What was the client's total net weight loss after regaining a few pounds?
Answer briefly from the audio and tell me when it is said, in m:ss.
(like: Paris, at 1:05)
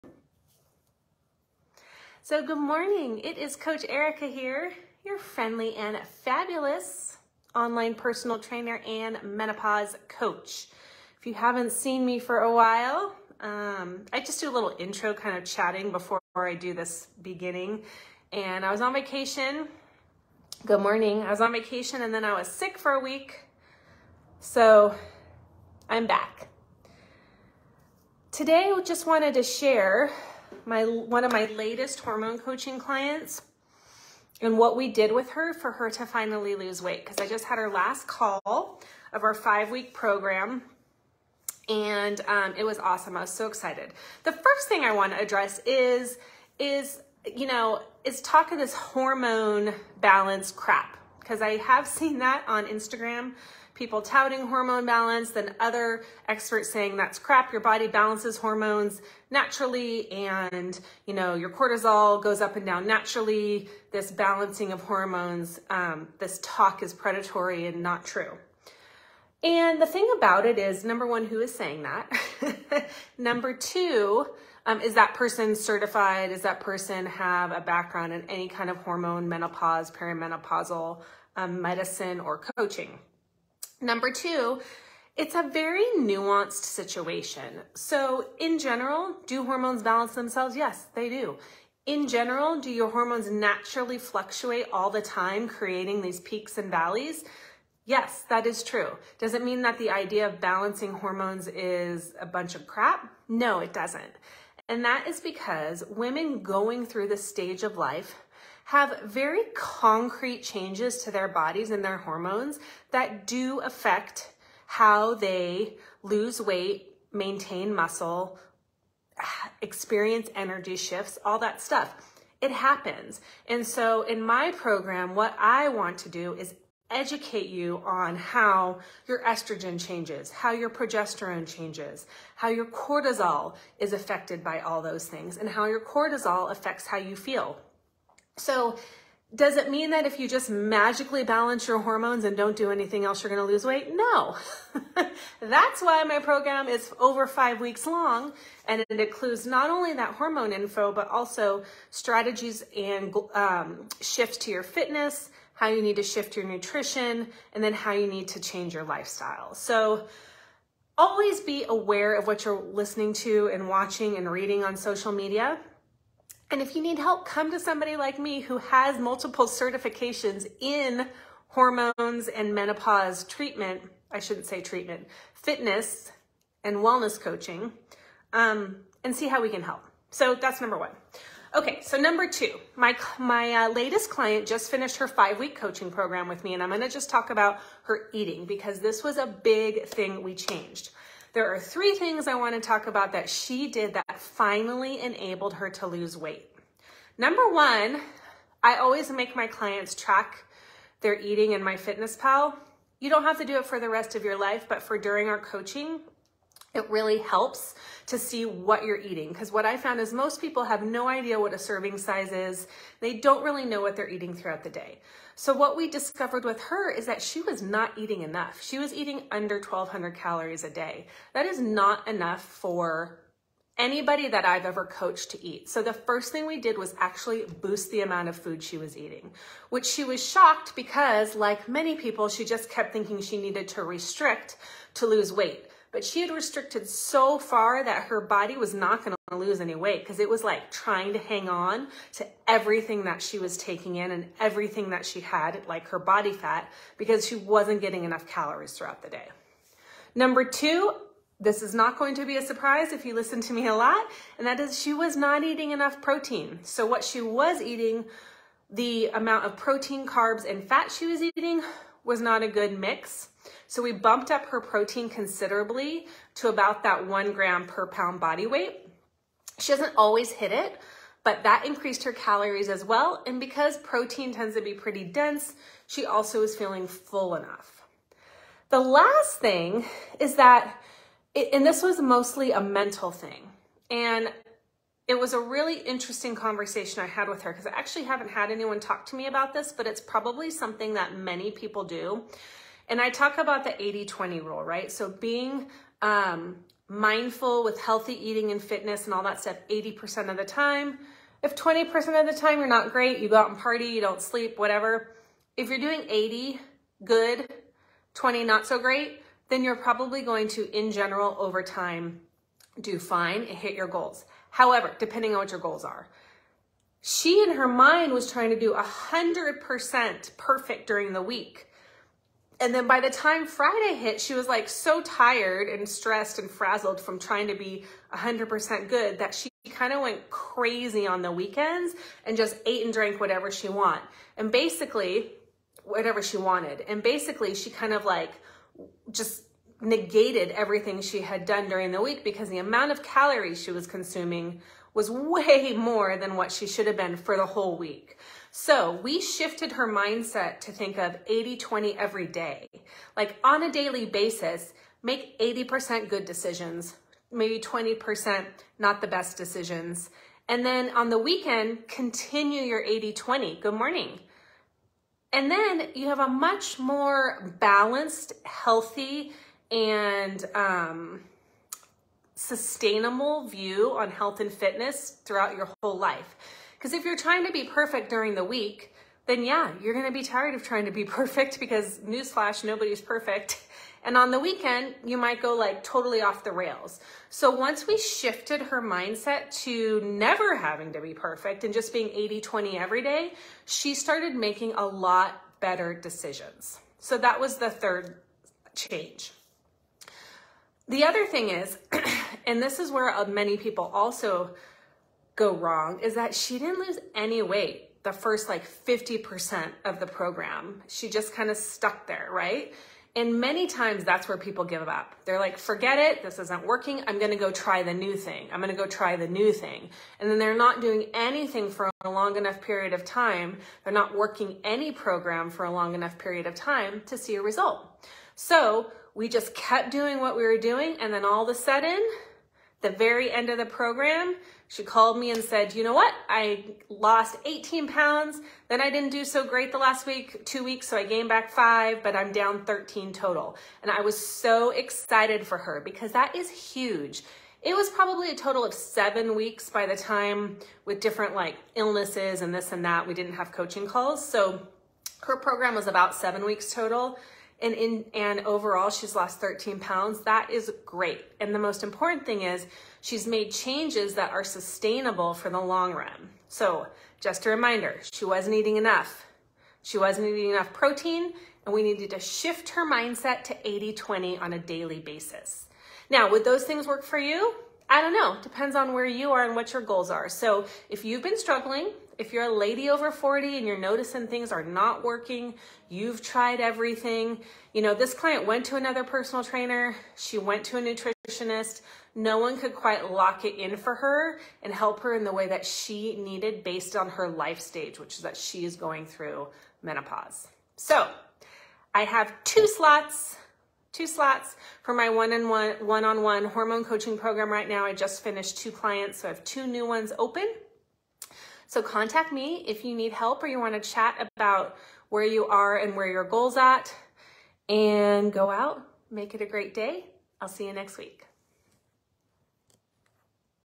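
13 pounds, at 7:22.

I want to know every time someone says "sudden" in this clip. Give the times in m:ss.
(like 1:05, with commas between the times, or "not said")
7:11.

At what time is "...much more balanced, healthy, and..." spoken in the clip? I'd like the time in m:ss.
6:06.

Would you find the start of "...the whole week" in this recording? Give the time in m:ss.
5:47.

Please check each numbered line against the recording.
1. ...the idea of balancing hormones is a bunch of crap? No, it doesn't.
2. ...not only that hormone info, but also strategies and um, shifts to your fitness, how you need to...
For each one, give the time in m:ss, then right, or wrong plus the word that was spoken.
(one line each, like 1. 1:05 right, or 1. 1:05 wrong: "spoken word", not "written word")
1. 1:39 right
2. 2:29 right.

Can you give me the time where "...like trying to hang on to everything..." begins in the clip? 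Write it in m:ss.
4:00.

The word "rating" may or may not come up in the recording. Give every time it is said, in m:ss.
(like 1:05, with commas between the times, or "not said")
not said.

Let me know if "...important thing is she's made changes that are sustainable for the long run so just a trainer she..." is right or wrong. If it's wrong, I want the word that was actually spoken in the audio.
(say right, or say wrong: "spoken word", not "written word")
wrong: "reminder", not "trainer".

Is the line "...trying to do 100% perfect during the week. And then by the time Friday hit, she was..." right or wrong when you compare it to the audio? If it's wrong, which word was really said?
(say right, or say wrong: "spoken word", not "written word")
right.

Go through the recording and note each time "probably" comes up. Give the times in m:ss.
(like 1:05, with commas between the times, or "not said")
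4:49, 5:09, 7:27.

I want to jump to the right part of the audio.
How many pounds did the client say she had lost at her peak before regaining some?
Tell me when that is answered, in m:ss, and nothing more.
7:17.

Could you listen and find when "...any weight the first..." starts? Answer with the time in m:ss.
6:47.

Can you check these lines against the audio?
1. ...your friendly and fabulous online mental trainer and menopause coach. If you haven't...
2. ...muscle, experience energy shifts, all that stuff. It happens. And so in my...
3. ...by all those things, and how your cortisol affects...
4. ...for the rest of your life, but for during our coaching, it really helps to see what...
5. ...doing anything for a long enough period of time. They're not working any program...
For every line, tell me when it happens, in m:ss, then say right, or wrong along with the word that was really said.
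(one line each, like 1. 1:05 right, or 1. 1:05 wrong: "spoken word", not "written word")
1. 0:05 wrong: "personal", not "mental"
2. 1:57 right
3. 2:14 right
4. 3:23 right
5. 7:00 right.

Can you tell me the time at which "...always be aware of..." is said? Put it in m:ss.
2:40.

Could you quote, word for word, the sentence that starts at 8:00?
So if you've been struggling if you're a lady over 40 and you're noticing things are not working, you've tried everything.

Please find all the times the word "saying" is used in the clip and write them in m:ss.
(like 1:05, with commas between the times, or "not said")
0:56, 1:11.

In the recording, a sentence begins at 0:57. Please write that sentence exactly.
Your body balances hormones naturally and, you know, your cortisol goes up and down naturally.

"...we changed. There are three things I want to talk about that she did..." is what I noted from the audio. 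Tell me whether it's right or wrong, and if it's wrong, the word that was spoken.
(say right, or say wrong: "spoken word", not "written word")
right.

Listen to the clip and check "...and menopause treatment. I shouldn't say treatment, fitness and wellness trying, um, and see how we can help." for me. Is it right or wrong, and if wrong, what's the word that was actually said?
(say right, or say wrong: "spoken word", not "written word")
wrong: "coaching", not "trying".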